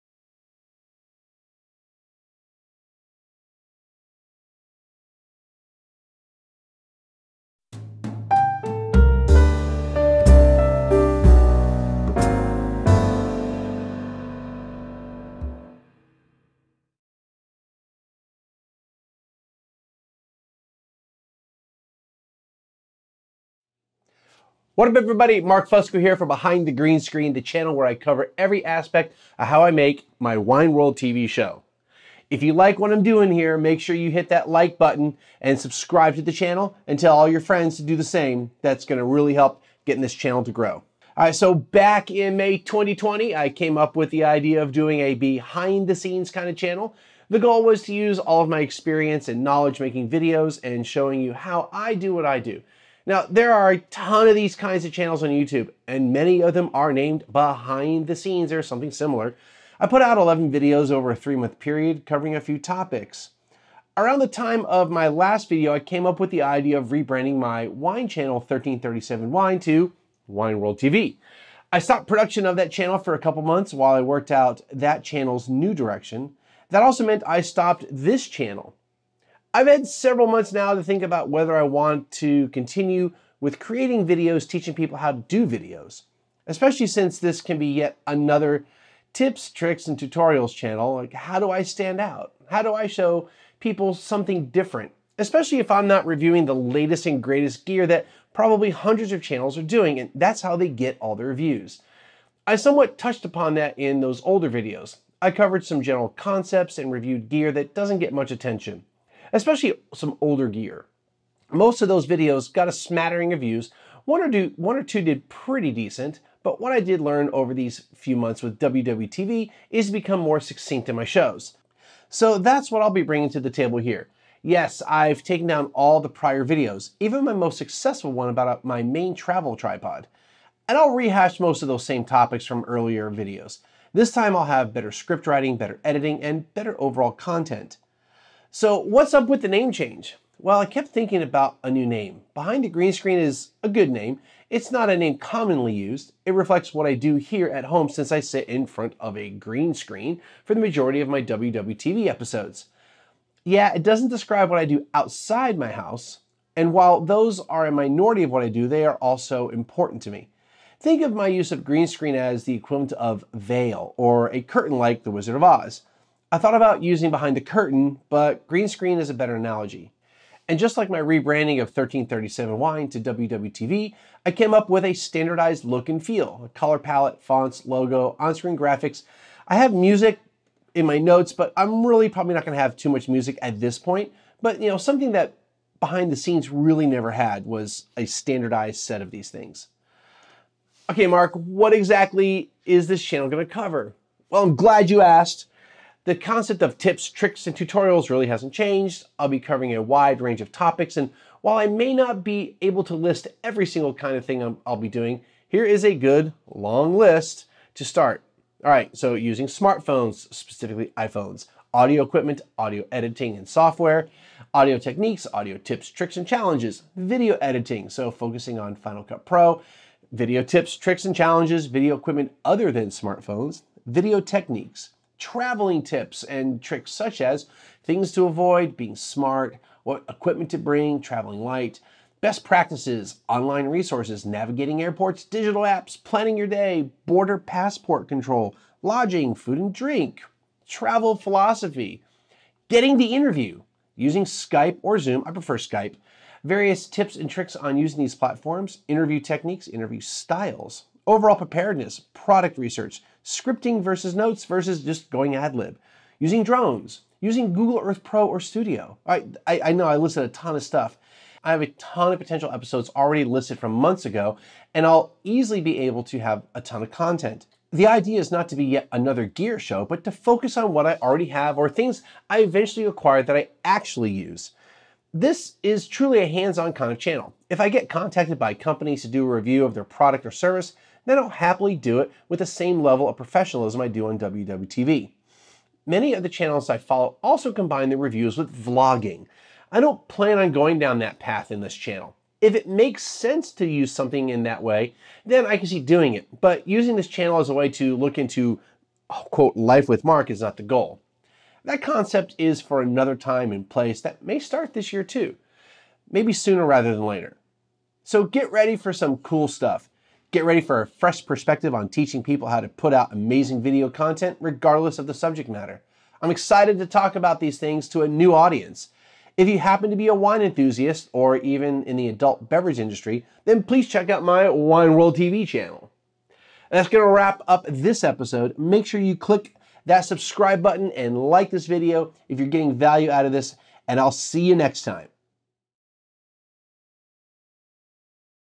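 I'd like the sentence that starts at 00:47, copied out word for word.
The goal was to use all of my experience and knowledge making videos and showing you how I do what I do.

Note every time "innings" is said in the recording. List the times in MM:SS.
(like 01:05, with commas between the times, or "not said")
not said.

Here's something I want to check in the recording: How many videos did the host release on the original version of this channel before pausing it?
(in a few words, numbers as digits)
11.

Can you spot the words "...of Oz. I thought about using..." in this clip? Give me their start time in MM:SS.
02:45.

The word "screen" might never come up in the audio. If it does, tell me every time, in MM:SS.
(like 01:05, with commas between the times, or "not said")
00:27, 02:22, 02:29, 02:41, 02:48, 02:58.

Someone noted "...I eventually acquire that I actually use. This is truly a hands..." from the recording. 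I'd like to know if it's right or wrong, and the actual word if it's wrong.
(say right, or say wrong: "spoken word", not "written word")
right.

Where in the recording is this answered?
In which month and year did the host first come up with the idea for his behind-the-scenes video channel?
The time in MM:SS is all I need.
00:42.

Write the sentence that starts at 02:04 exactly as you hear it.
Yes, I've taken down all the prior videos, even my most successful one about my main travel tripod.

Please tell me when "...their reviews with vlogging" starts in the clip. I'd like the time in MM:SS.
04:47.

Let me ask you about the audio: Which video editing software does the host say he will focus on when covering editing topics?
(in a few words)
Final Cut Pro.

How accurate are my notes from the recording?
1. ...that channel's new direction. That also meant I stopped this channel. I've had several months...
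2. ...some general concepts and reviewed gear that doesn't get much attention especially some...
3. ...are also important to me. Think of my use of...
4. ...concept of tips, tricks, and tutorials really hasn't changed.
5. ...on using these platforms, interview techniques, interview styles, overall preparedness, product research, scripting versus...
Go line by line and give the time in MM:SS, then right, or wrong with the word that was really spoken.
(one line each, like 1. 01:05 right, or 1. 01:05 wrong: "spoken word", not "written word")
1. 01:14 right
2. 01:45 right
3. 02:38 right
4. 03:16 right
5. 04:07 right.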